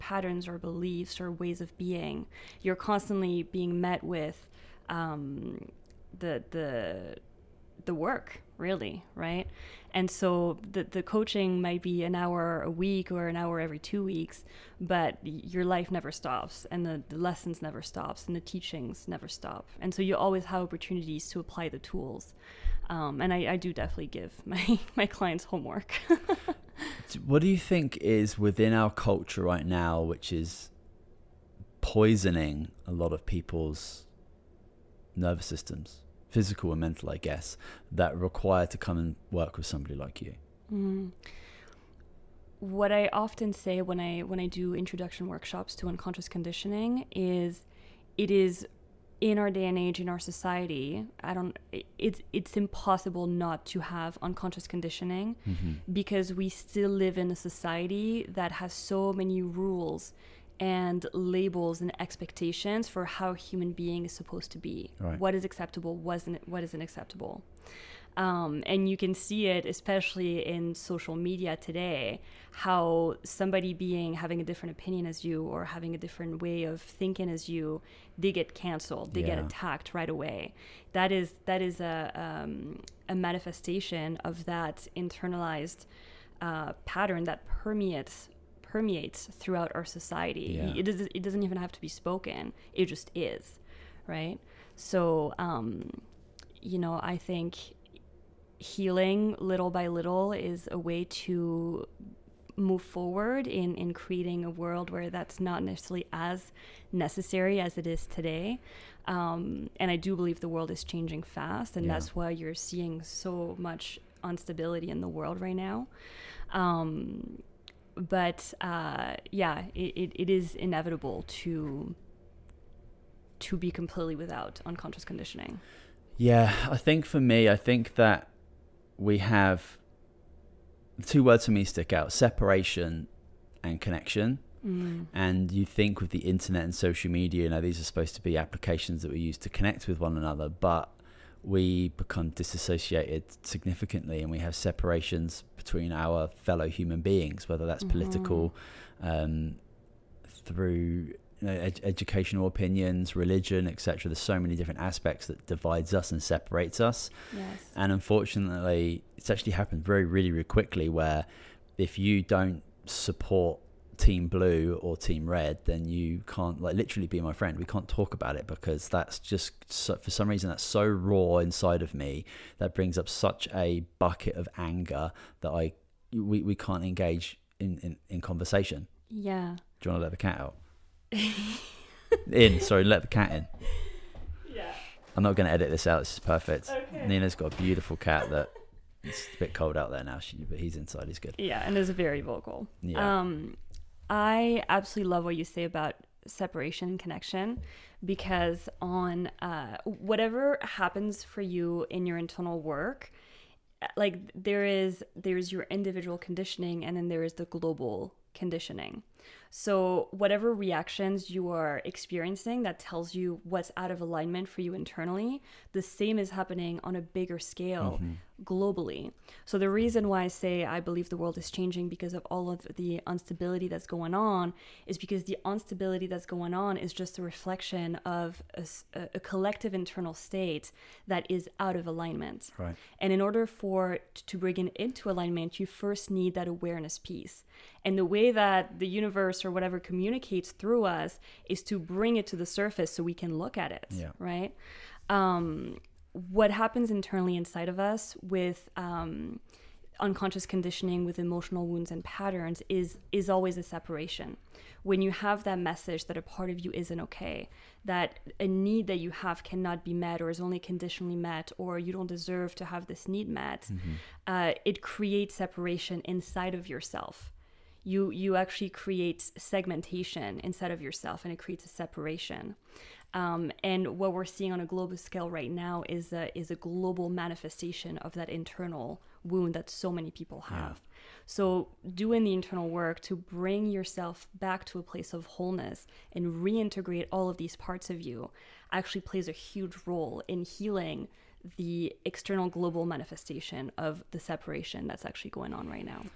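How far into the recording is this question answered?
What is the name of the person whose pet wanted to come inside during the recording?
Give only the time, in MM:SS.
03:07.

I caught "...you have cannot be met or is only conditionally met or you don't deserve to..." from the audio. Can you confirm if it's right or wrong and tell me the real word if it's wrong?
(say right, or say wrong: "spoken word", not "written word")
right.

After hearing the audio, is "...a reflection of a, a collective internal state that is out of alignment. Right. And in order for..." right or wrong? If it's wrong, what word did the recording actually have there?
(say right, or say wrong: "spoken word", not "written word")
right.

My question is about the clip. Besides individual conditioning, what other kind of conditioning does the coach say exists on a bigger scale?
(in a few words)
Global conditioning.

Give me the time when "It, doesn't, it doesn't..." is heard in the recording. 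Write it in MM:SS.
01:30.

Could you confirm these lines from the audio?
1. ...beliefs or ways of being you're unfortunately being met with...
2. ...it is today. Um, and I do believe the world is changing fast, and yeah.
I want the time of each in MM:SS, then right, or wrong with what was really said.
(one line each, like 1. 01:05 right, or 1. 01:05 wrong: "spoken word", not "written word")
1. 00:00 wrong: "constantly", not "unfortunately"
2. 01:47 right.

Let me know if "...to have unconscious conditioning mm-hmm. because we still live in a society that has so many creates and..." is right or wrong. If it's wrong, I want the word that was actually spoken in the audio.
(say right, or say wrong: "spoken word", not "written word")
wrong: "rules", not "creates".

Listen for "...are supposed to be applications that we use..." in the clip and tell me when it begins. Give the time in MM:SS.
02:17.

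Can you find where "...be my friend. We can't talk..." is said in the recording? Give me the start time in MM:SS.
02:47.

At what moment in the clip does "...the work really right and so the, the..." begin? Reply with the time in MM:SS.
00:07.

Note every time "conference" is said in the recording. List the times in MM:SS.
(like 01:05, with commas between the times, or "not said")
not said.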